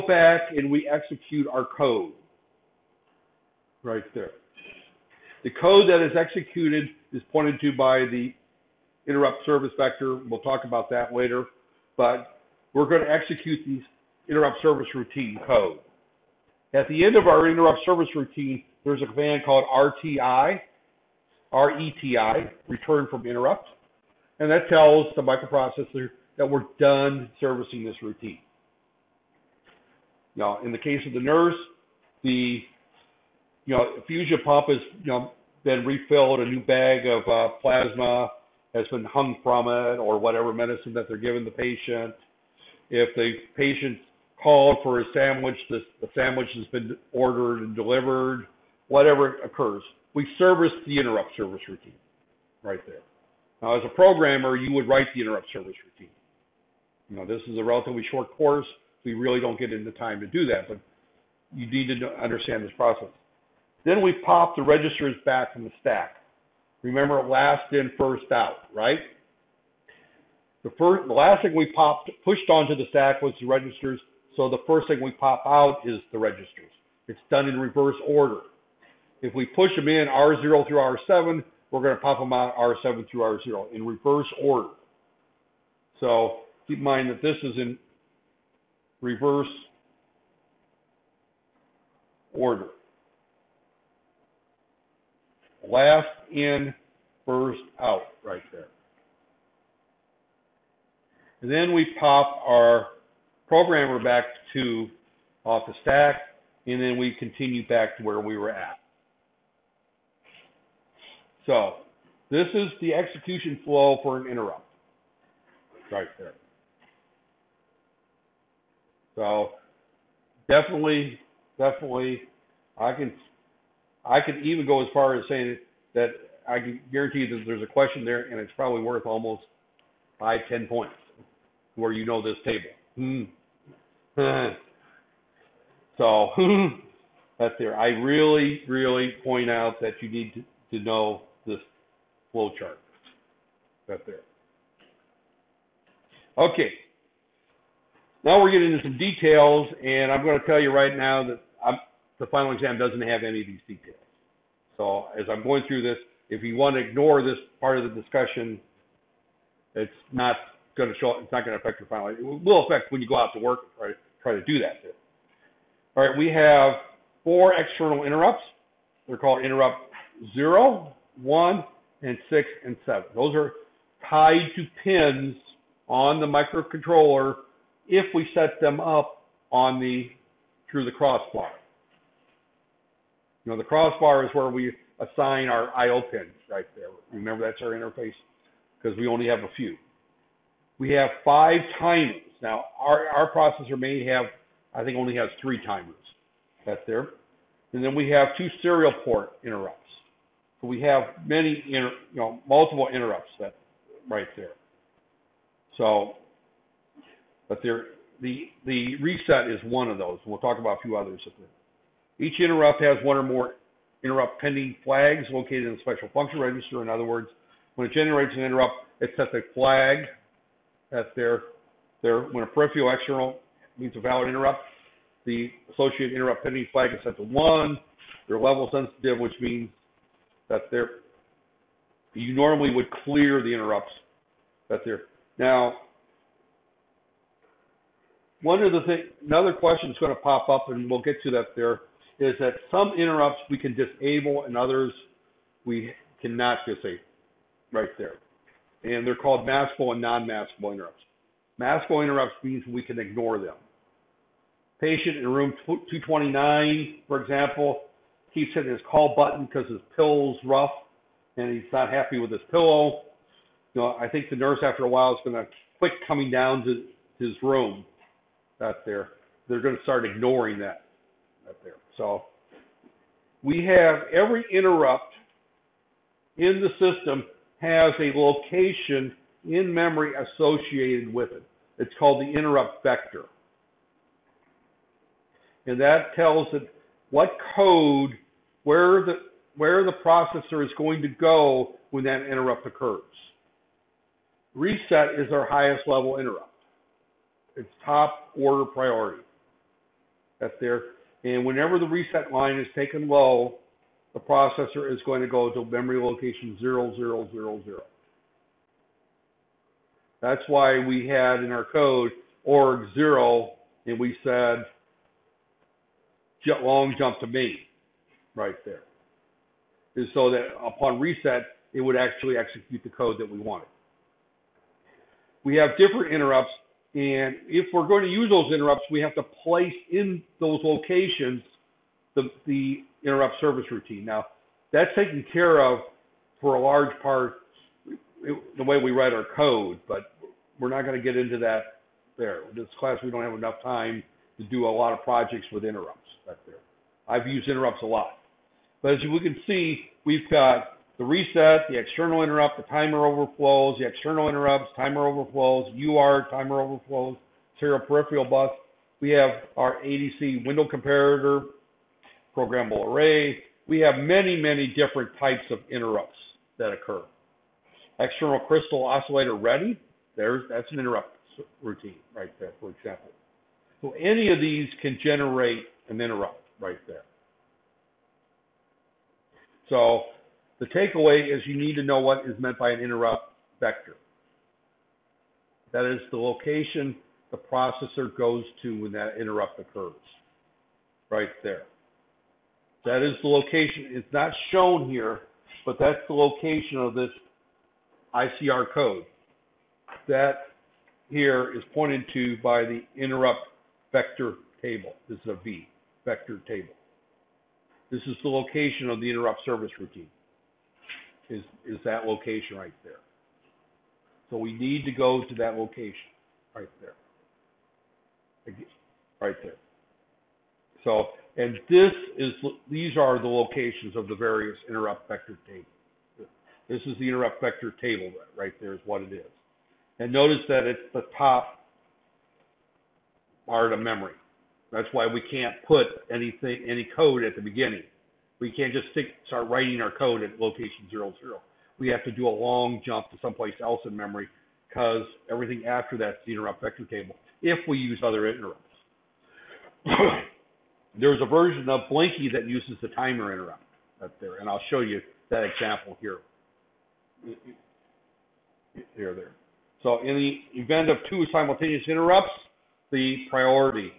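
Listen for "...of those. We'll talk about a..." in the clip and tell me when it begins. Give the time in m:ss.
3:29.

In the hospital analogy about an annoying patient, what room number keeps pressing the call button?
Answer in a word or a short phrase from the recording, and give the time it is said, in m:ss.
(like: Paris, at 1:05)
229, at 4:15.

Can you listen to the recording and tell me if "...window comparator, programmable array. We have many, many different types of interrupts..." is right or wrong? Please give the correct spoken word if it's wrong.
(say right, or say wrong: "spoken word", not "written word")
right.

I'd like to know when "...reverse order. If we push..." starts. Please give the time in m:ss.
1:17.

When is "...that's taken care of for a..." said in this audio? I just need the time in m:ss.
5:34.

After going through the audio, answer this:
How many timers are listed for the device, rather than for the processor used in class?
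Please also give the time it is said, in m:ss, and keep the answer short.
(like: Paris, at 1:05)
5, at 3:11.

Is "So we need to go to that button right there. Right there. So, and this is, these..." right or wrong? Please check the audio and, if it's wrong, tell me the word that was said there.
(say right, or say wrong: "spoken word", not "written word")
wrong: "location", not "button".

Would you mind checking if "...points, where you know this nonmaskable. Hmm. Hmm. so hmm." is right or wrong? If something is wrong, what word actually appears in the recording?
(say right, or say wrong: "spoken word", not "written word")
wrong: "table", not "nonmaskable".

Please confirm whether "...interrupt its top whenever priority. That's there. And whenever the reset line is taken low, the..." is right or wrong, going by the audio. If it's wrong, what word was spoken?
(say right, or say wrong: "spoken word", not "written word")
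wrong: "order", not "whenever".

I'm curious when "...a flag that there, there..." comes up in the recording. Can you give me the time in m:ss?
3:39.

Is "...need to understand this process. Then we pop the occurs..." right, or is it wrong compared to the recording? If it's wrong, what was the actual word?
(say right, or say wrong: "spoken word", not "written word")
wrong: "registers", not "occurs".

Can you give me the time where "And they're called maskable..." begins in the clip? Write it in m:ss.
4:08.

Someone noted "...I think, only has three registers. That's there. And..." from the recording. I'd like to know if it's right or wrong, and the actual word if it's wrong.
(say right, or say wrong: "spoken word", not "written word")
wrong: "timers", not "registers".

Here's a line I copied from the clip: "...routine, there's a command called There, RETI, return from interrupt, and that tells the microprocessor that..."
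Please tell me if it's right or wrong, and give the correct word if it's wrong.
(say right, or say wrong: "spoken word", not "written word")
wrong: "RTI", not "There".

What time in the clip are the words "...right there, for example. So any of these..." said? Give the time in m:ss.
6:12.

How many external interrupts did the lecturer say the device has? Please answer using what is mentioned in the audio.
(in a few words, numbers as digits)
4.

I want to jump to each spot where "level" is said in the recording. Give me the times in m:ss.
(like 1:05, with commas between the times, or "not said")
3:48, 4:55.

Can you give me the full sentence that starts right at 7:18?
We can't just stick, start writing our code at location zero zero.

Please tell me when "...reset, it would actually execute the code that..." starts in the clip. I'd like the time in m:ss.
5:20.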